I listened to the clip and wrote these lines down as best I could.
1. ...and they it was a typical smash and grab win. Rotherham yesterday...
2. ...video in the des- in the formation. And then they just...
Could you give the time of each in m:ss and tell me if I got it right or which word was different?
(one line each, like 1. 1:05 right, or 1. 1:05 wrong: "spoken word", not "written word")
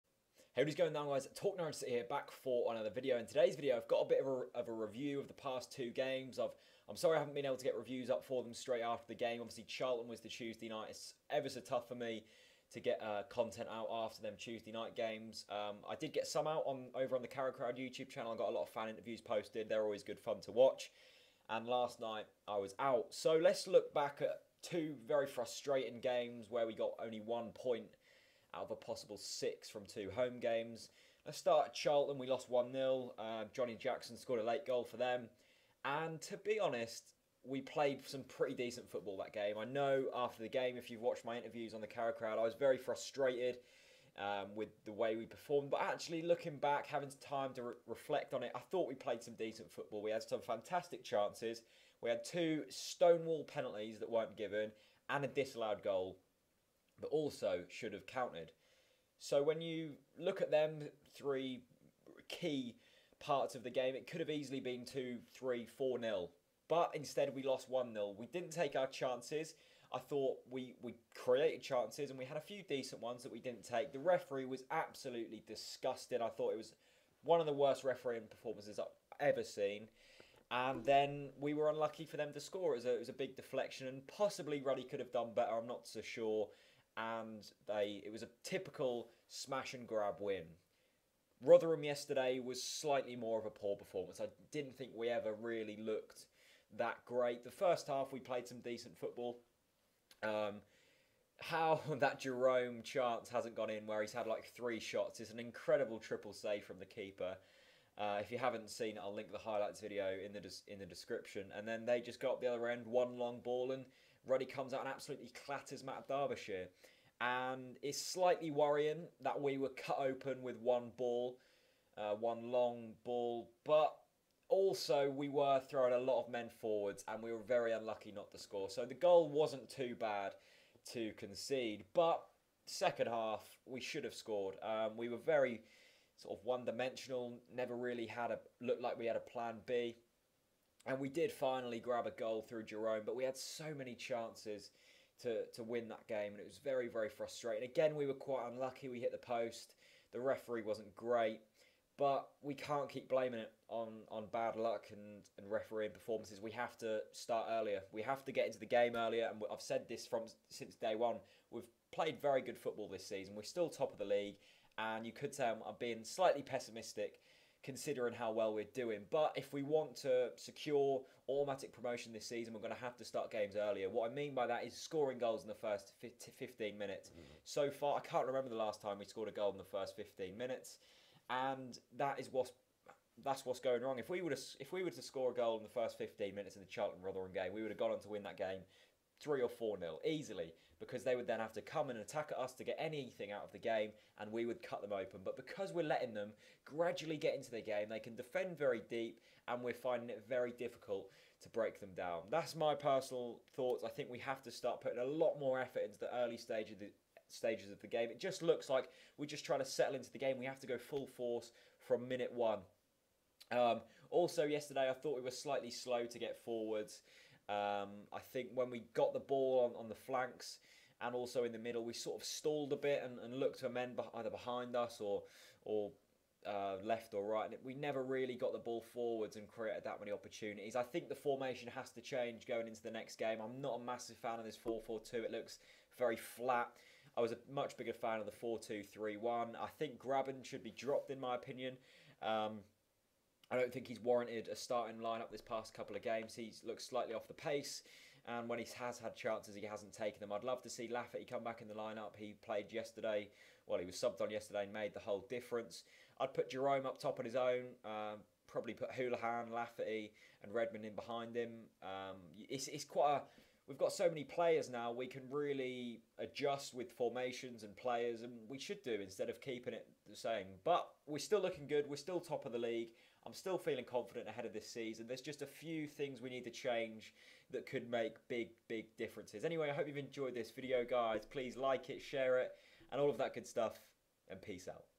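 1. 1:26 right
2. 1:49 wrong: "description", not "formation".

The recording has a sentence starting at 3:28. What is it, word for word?
It just looks like we're just trying to settle into the game.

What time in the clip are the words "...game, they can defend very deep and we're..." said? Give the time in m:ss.
3:17.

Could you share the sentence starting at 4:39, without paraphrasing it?
Anyway, I hope you've enjoyed this video, guys.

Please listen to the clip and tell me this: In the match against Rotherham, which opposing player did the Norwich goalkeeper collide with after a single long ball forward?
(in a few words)
Matt Derbyshire.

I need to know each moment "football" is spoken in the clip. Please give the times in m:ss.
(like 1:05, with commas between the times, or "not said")
0:38, 0:49, 1:38, 2:42.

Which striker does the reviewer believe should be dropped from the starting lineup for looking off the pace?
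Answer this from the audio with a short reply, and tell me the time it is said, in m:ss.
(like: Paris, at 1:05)
Grabban, at 3:59.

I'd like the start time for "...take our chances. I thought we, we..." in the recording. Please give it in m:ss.
1:08.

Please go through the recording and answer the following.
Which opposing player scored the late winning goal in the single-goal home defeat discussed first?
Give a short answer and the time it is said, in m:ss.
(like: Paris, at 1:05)
Johnny Jackson, at 0:33.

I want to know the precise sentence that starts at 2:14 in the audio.
Um, we were very sort of one dimensional, never really had a looked like we had a plan B.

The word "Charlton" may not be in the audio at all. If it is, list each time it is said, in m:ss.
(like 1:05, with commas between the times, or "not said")
0:09, 0:31, 3:06.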